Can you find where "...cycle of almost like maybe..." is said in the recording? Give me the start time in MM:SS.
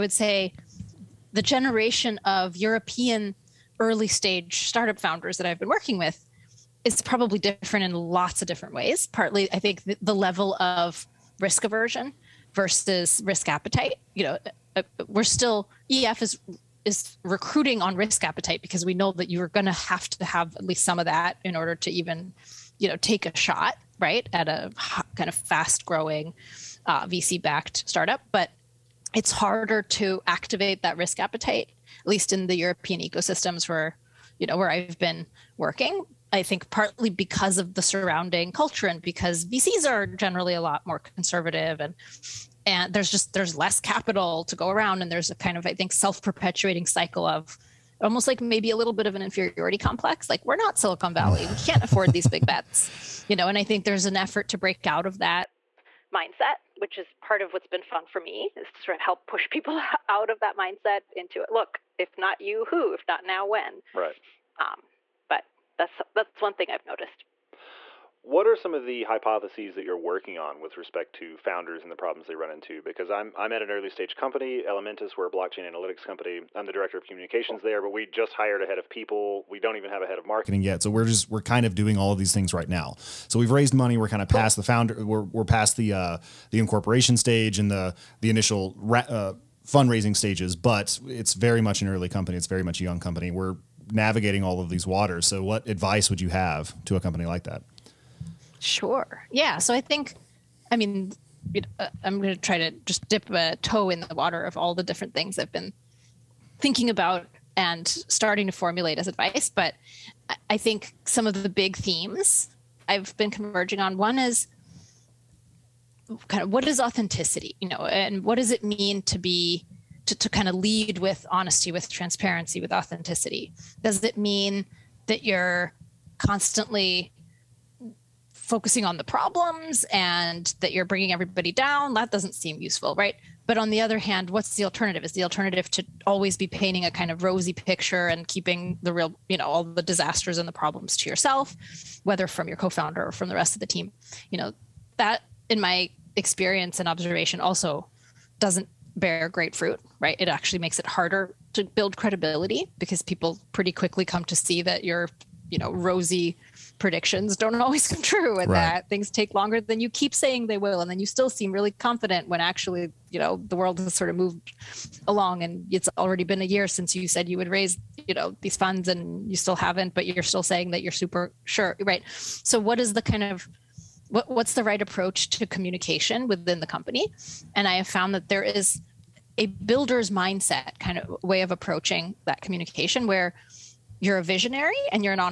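00:46.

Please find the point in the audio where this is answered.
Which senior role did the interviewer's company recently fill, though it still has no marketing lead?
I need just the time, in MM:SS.
01:18.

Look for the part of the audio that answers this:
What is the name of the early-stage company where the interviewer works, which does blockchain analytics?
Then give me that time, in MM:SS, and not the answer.
01:14.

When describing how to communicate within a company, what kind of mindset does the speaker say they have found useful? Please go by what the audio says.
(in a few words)
Builder's mindset.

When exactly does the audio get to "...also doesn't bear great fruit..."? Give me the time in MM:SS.
02:27.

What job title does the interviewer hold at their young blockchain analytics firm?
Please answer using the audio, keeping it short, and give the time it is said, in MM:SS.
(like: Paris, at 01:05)
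Director of communications, at 01:16.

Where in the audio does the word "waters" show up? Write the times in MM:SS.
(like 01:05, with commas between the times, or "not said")
01:34, 01:44.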